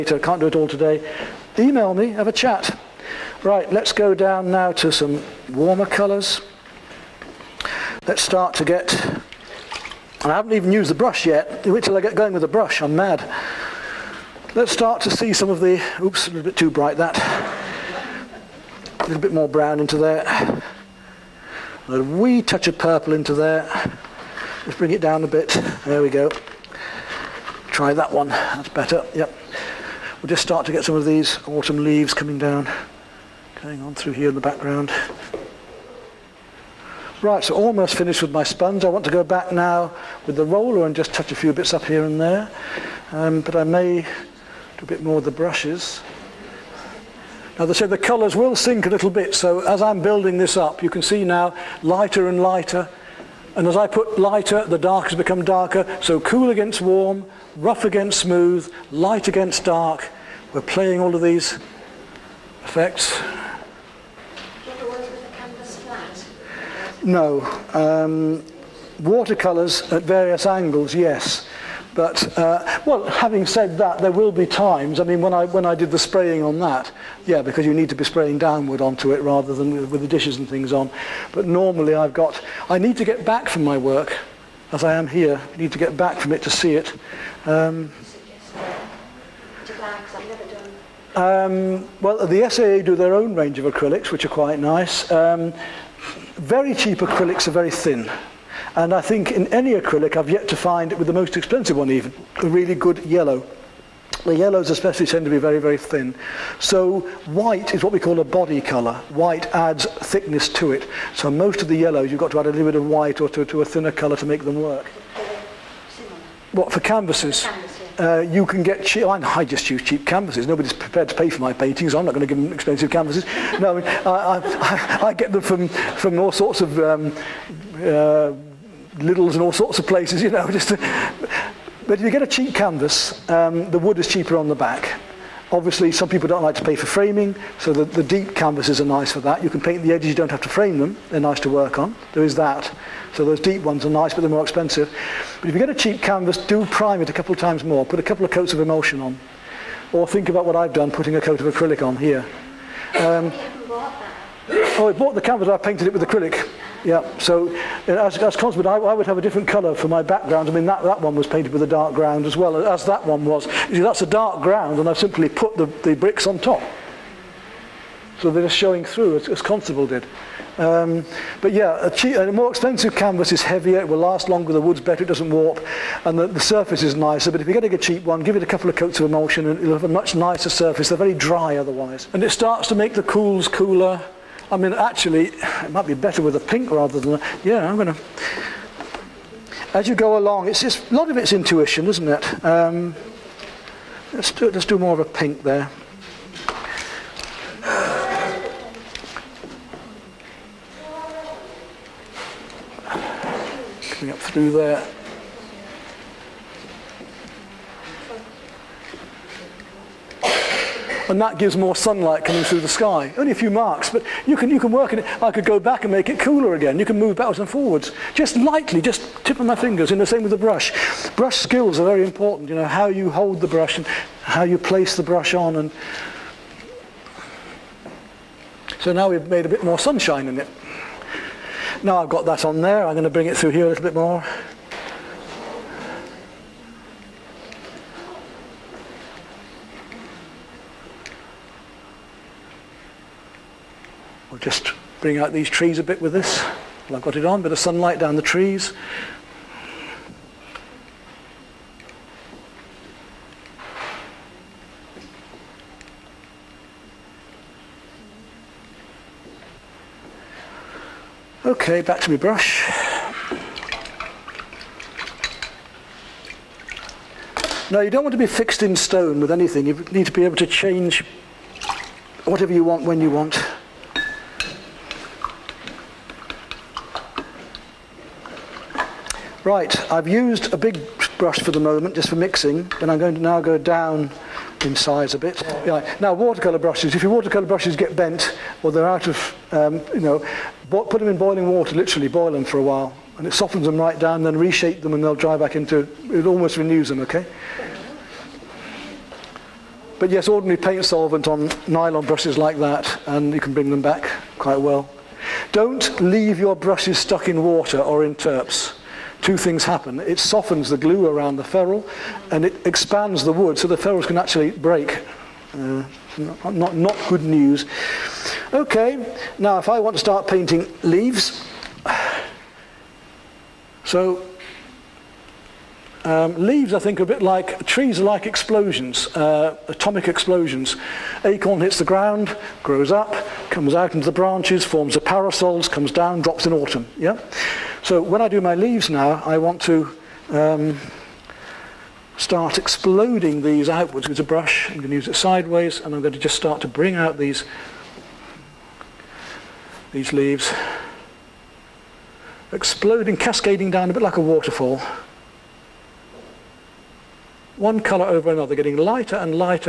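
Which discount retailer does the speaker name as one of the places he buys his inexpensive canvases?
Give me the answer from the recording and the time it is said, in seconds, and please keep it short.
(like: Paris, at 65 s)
Lidl's, at 128 s.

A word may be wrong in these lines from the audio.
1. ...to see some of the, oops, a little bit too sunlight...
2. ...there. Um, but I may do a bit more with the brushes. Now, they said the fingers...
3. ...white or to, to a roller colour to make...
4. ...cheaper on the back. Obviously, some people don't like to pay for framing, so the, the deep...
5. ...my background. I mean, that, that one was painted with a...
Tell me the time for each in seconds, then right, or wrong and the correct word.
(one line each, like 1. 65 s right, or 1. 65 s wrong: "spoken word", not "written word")
1. 15 s wrong: "bright", not "sunlight"
2. 42 s wrong: "colours", not "fingers"
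3. 112 s wrong: "thinner", not "roller"
4. 134 s right
5. 159 s right.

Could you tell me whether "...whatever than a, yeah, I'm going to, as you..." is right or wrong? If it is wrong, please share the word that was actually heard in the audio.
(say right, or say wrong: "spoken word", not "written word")
wrong: "rather", not "whatever".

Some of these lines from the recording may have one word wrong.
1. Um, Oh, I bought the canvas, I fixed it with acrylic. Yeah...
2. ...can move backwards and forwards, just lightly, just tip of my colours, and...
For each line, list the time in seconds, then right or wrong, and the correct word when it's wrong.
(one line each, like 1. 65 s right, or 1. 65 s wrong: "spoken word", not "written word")
1. 152 s wrong: "painted", not "fixed"
2. 216 s wrong: "fingers", not "colours".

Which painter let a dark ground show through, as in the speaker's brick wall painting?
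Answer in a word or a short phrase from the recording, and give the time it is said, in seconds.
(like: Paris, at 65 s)
Constable, at 169 s.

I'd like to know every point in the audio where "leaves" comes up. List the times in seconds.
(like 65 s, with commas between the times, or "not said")
31 s, 305 s, 320 s, 326 s, 338 s, 350 s.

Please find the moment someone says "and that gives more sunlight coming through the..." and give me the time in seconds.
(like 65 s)
211 s.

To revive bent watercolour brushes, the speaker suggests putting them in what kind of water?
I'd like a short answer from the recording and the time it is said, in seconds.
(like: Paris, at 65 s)
boiling water, at 291 s.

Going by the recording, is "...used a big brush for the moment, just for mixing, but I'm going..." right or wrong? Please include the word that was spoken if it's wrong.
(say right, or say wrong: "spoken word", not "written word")
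right.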